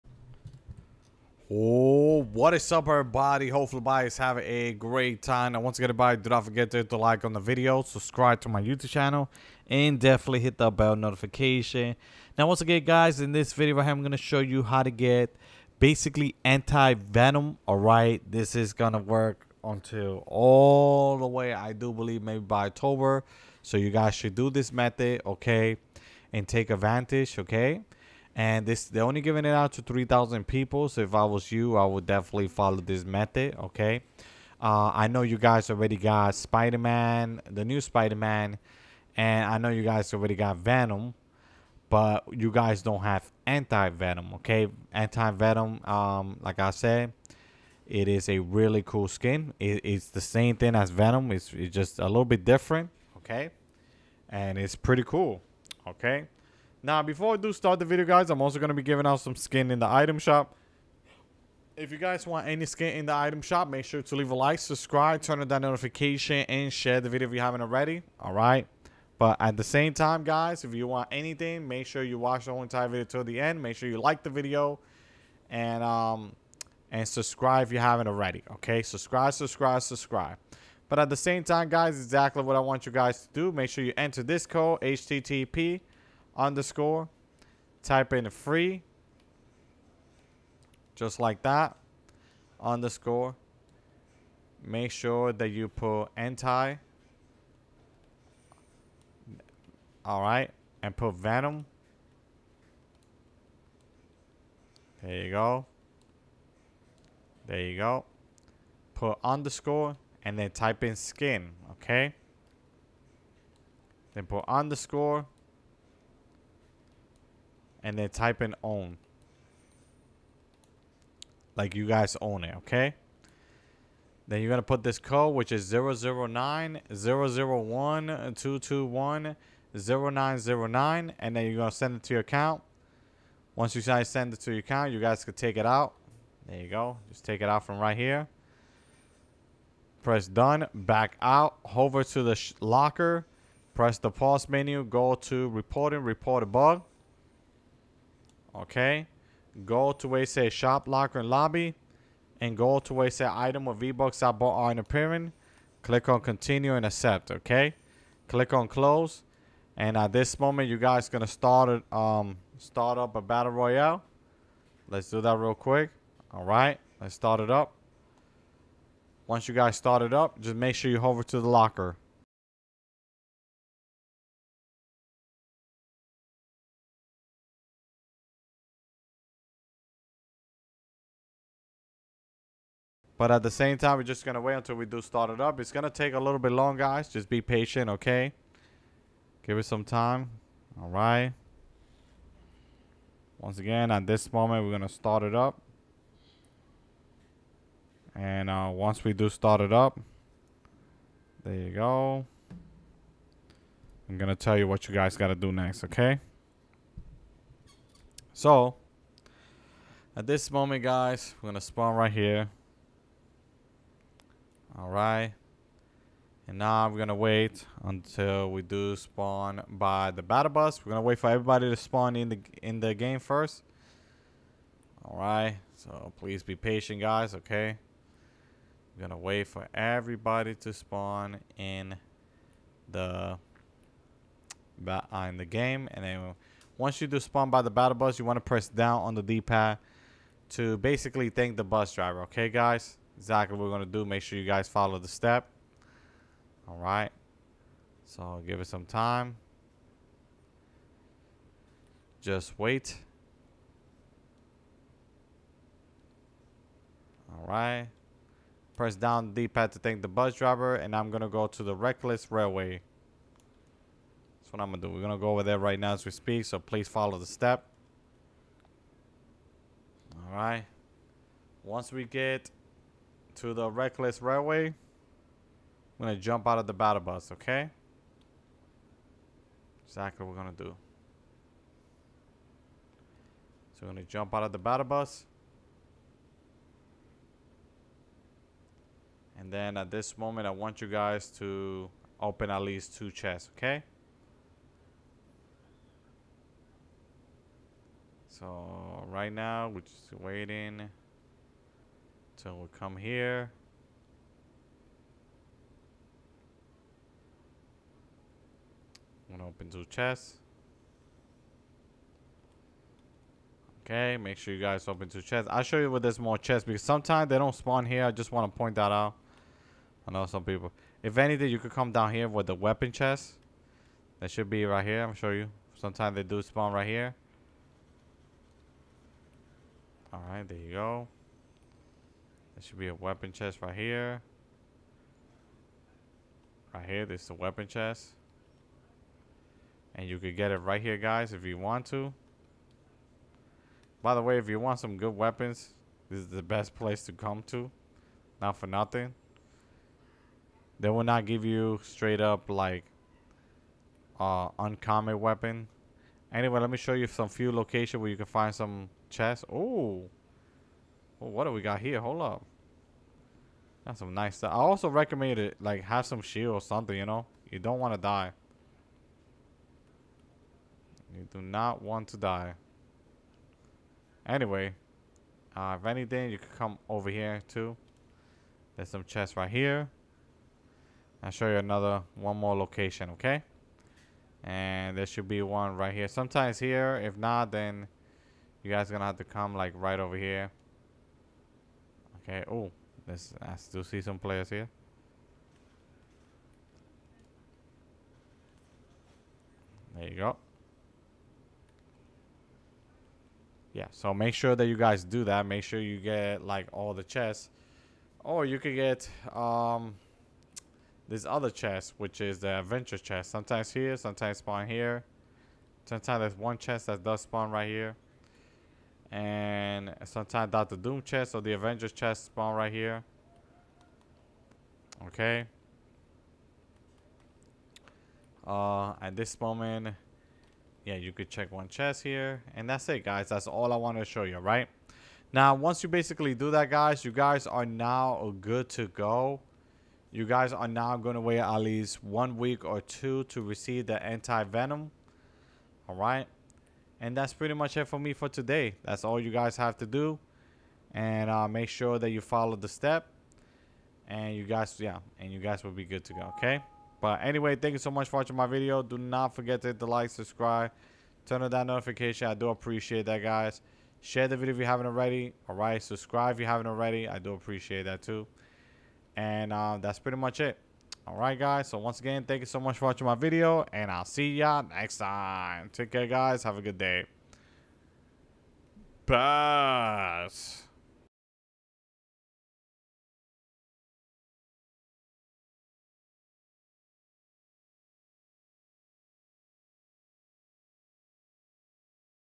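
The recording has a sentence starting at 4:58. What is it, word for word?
So right now, we're just waiting.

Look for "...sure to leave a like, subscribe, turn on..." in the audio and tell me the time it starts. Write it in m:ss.
1:03.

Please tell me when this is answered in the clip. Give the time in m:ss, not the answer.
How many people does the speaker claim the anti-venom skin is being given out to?
0:29.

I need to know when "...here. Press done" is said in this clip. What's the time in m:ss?
2:17.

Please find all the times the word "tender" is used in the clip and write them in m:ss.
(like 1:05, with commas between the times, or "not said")
not said.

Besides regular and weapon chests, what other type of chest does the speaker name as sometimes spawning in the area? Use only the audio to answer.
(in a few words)
Adventure chest.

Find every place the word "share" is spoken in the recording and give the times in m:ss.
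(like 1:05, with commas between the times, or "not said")
1:06, 7:44.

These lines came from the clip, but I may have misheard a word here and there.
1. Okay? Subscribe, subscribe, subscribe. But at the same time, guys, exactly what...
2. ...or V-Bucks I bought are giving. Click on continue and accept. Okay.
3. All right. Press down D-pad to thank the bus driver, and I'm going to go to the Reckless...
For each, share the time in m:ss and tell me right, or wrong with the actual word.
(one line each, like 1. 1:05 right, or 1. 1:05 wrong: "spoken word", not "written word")
1. 1:18 right
2. 2:33 wrong: "appearing", not "giving"
3. 4:17 right.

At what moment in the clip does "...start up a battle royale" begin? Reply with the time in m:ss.
2:42.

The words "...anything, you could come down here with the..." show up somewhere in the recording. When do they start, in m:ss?
5:21.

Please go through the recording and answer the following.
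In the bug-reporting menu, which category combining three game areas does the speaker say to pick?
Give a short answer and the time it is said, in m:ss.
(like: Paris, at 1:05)
Shop, locker, and lobby, at 2:30.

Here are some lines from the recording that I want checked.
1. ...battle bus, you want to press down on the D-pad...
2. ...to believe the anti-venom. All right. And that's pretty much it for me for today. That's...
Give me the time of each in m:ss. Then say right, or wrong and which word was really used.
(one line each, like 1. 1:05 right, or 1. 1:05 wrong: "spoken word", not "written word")
1. 3:57 right
2. 7:23 wrong: "receive", not "believe".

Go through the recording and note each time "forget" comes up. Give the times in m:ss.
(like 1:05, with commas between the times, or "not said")
0:06, 7:39.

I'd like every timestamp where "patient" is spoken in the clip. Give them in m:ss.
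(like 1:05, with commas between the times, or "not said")
3:07, 3:46.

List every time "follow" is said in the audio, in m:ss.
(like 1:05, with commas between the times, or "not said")
0:32, 4:04, 4:26, 7:32.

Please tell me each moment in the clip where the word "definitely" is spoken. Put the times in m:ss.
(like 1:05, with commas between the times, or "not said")
0:09, 0:32.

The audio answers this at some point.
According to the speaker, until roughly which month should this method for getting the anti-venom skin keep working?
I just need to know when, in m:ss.
0:22.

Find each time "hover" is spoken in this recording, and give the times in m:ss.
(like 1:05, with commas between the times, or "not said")
2:21, 2:50.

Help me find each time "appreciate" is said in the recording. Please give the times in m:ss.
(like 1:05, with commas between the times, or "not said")
7:42, 7:47.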